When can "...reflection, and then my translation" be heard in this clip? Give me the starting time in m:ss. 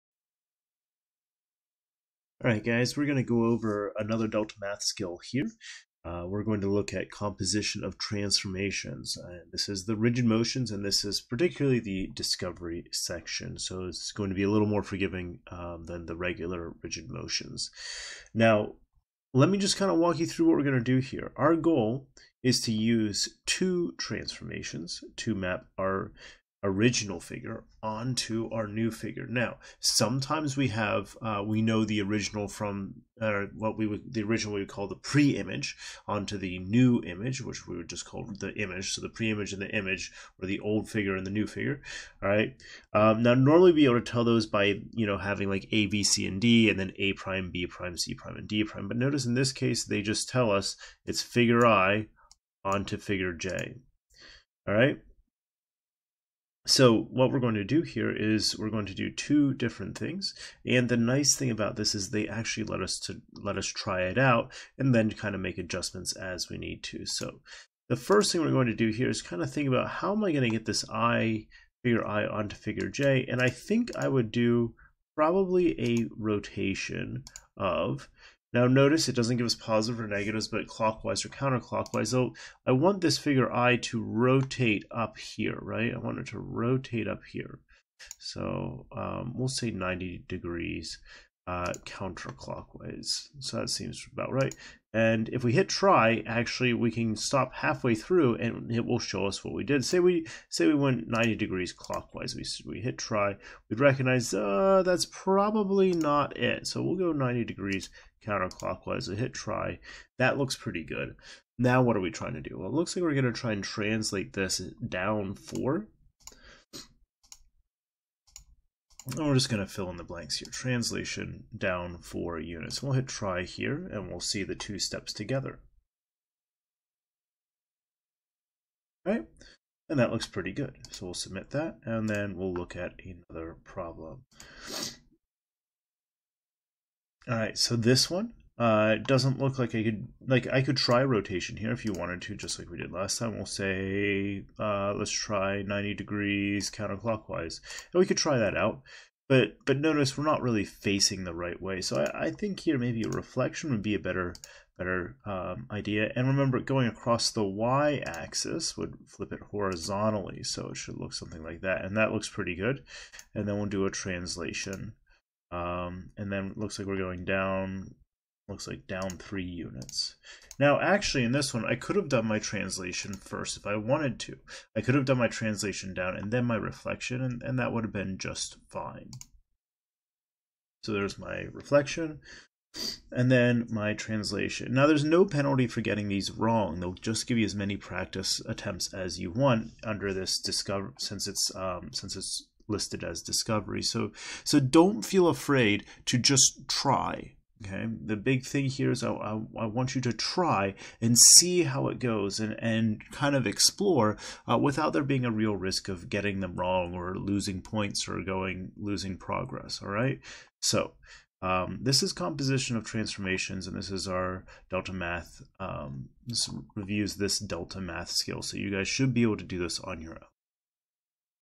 3:01.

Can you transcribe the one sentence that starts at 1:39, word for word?
Say we say we went 90 degrees clockwise, we, we hit try, we'd recognize uh, that's probably not it.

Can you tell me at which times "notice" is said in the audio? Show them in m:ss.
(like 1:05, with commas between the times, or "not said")
0:48, 1:18, 2:29.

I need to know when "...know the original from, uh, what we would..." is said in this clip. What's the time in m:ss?
0:31.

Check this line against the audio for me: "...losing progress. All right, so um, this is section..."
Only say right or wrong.
wrong.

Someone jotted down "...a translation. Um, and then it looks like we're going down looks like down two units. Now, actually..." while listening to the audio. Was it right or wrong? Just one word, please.
wrong.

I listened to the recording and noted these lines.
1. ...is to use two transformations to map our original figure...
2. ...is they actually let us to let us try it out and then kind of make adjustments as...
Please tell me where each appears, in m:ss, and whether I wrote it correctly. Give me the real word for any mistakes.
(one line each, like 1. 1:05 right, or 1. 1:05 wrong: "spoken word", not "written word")
1. 0:22 right
2. 1:01 right.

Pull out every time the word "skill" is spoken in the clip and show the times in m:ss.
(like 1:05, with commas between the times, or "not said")
0:04, 3:38.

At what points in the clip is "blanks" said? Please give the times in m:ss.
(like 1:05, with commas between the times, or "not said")
2:00.